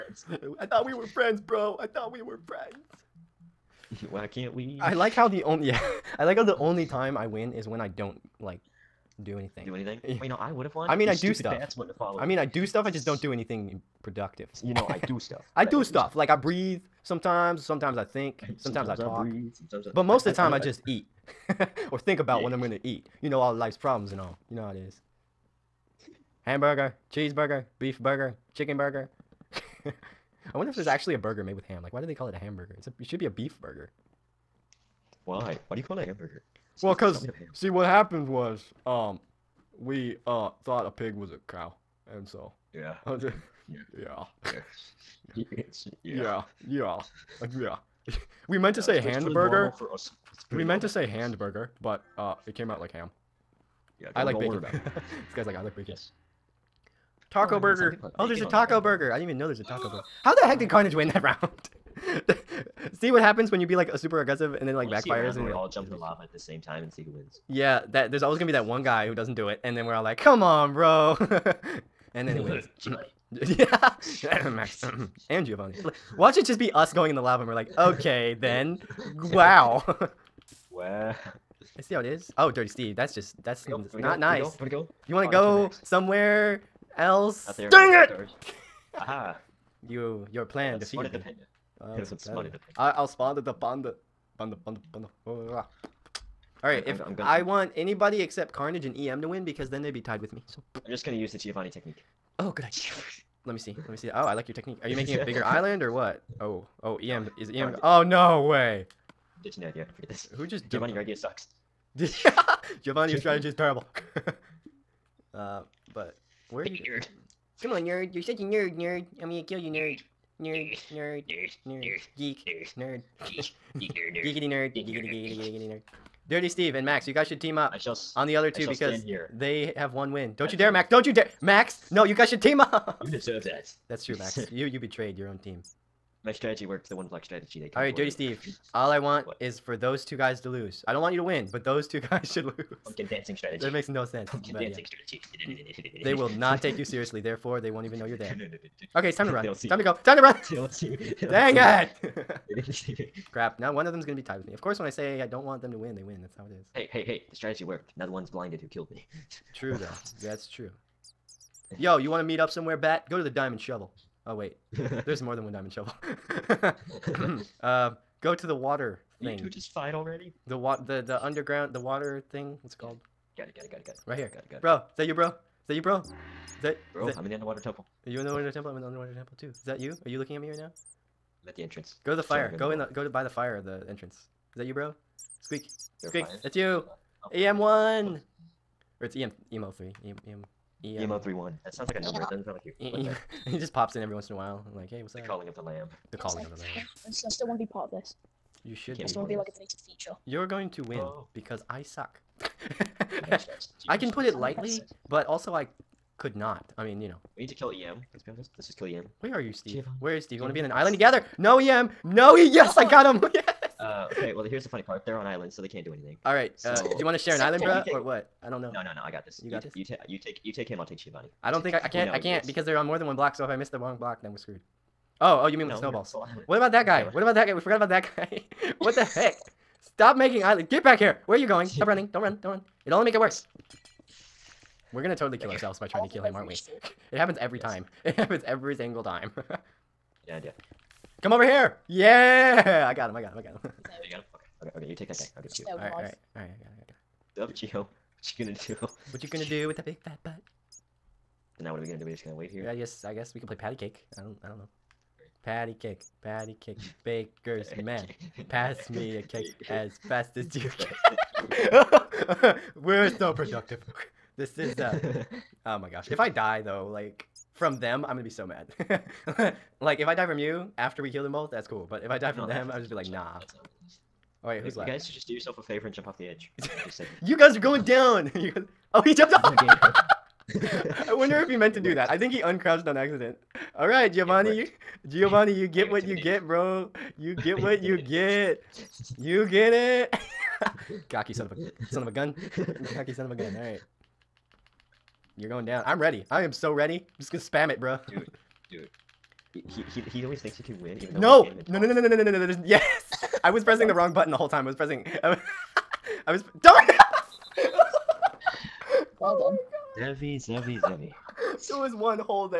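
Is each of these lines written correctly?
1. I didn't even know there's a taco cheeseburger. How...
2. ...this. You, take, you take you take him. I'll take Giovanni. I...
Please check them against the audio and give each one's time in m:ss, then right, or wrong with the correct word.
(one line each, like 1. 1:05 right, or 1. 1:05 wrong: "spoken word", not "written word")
1. 0:59 wrong: "burger", not "cheeseburger"
2. 3:39 right.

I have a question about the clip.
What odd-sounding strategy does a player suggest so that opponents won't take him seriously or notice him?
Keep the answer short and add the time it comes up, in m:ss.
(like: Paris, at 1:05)
Pumpkin dancing strategy, at 2:22.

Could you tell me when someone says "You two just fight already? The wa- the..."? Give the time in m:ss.
2:49.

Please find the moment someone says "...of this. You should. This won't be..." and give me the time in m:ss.
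3:17.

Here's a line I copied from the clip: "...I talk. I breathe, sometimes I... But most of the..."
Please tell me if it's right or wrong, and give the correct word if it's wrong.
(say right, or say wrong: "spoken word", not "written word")
right.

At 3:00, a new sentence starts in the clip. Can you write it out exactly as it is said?
Are you looking at me right now?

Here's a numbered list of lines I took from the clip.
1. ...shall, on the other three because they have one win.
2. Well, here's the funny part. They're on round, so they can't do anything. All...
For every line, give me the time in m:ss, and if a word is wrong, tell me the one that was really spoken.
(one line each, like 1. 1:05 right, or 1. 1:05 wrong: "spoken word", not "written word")
1. 2:07 wrong: "two", not "three"
2. 3:34 wrong: "island", not "round".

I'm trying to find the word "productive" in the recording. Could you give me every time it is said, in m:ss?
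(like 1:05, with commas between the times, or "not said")
0:14, 4:23.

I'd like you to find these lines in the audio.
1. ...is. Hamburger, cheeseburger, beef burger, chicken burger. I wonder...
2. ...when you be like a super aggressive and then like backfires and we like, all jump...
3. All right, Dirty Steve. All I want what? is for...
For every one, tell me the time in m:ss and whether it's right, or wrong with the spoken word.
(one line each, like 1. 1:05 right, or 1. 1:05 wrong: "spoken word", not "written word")
1. 0:24 right
2. 1:03 right
3. 2:17 right.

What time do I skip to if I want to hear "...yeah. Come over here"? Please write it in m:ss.
4:00.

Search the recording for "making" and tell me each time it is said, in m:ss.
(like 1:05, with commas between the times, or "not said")
1:44, 3:50.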